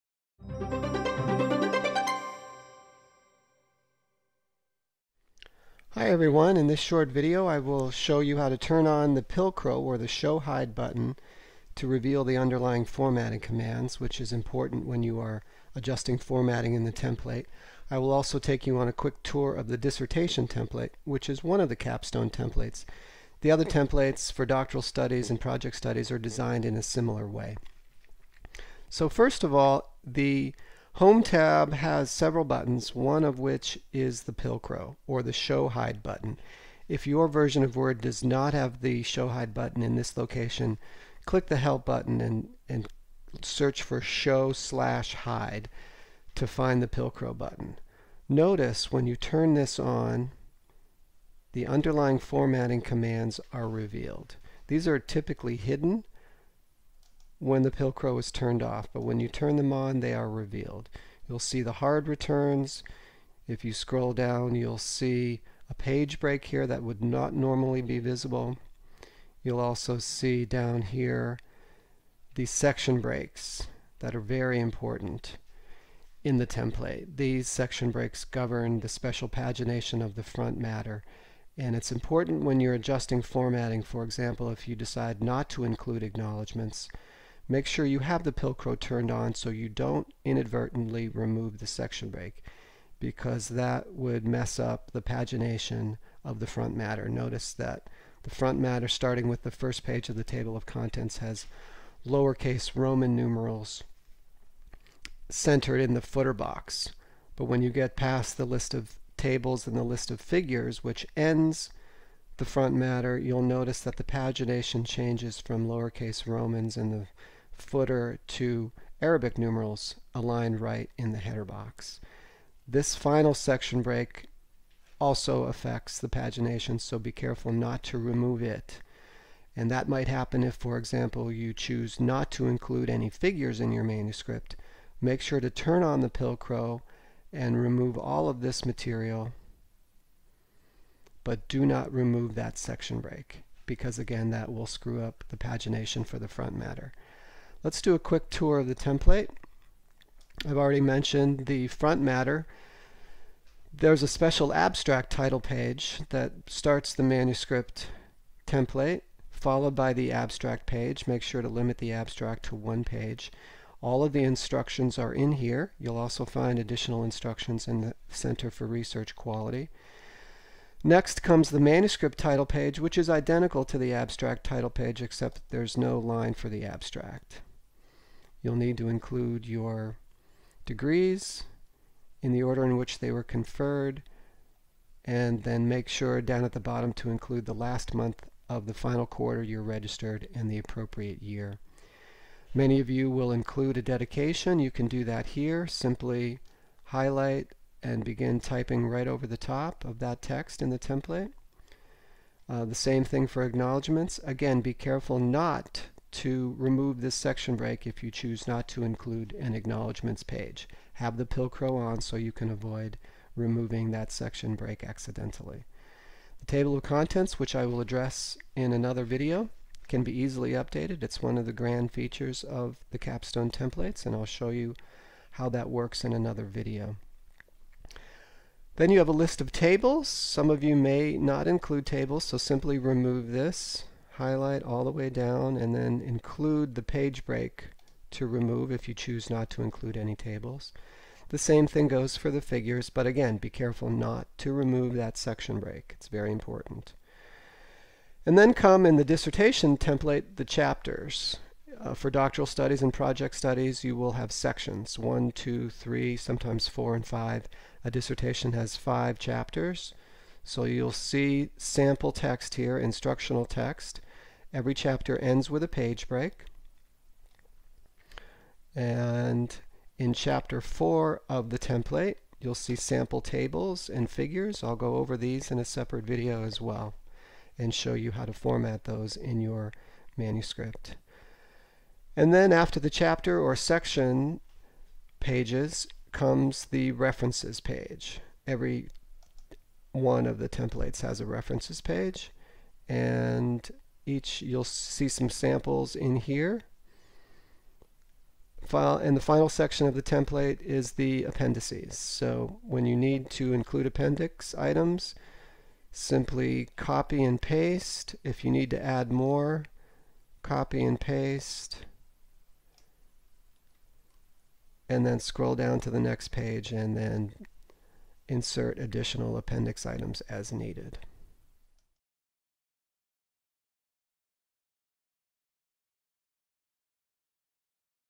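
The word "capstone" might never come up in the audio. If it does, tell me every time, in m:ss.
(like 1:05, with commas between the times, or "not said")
0:21, 3:42.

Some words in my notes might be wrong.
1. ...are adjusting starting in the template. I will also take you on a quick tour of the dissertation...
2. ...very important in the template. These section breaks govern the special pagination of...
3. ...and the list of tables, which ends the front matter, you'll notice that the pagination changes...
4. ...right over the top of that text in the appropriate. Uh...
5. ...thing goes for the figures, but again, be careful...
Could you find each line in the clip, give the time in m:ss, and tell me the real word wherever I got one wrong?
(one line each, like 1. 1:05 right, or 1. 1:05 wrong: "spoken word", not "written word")
1. 0:15 wrong: "formatting", not "starting"
2. 1:14 right
3. 1:49 wrong: "figures", not "tables"
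4. 3:18 wrong: "template", not "appropriate"
5. 4:01 right.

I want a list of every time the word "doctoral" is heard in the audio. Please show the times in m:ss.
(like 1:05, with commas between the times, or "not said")
0:24, 4:12.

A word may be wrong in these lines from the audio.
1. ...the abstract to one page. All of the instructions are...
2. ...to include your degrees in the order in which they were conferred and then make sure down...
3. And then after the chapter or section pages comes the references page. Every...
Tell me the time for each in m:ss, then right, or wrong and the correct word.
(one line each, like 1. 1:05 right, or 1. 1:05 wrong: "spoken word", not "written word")
1. 2:41 right
2. 2:58 right
3. 4:42 right.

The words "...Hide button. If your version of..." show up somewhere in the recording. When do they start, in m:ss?
0:35.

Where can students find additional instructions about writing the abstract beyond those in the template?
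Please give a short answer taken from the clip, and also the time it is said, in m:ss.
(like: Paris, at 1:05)
Center for Research Quality, at 2:48.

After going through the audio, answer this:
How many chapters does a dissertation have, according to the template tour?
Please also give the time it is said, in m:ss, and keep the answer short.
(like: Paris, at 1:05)
5, at 4:18.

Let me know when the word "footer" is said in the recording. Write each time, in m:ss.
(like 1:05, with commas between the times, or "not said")
1:45, 1:57.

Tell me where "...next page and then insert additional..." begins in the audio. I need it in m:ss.
5:15.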